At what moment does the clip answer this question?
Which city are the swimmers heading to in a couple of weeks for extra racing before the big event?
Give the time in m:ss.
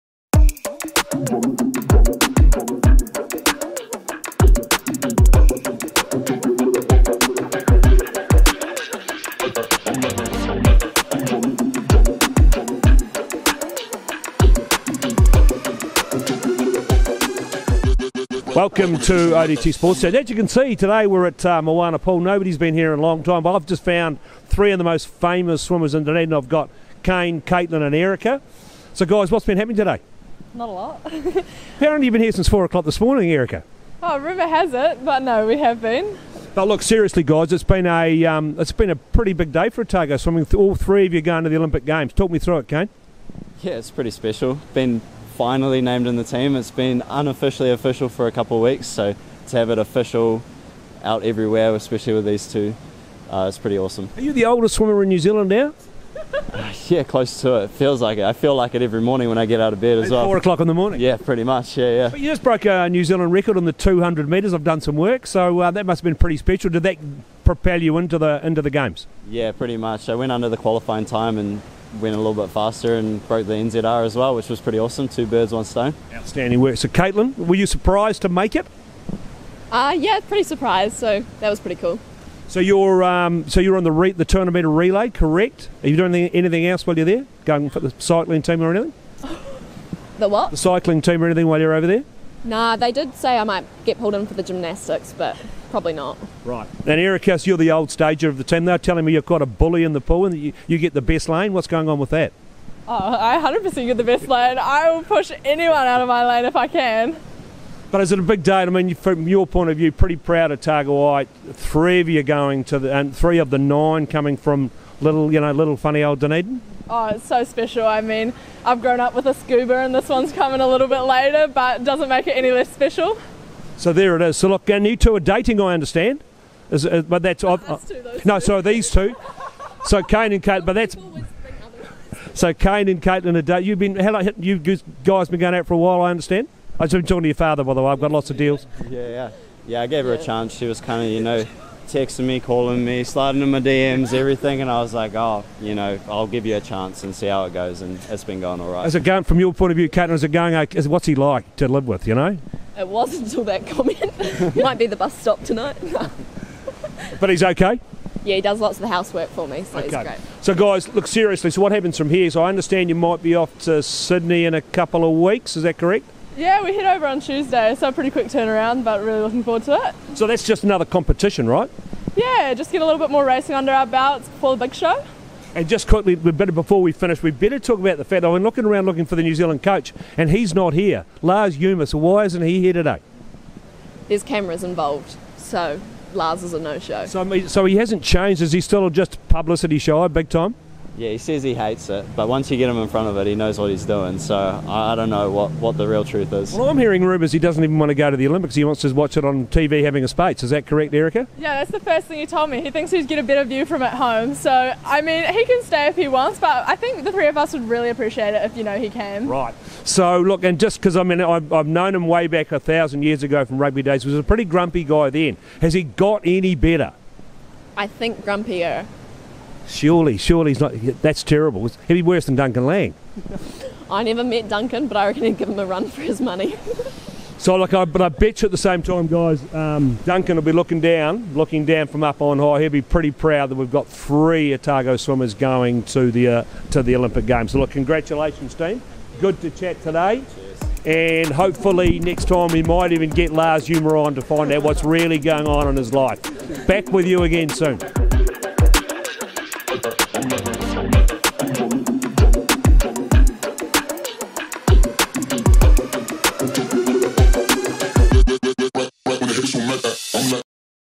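2:43.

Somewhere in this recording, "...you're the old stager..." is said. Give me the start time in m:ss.
1:37.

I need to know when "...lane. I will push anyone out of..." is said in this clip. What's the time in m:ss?
1:44.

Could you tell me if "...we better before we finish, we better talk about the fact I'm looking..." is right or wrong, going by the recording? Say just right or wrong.
right.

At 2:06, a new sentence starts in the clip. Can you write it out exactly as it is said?
Is, uh, but that's no, that's two, no two.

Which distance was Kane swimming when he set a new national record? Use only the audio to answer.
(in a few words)
200 metres.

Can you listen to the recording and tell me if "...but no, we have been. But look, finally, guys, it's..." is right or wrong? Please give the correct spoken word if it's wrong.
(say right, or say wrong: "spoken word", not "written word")
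wrong: "seriously", not "finally".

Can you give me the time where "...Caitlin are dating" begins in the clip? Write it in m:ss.
2:13.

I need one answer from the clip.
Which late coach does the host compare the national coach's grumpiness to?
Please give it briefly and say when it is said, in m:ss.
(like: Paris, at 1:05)
Duncan Laing, at 3:42.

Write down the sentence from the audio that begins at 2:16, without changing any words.
I was talking to your father, by the way.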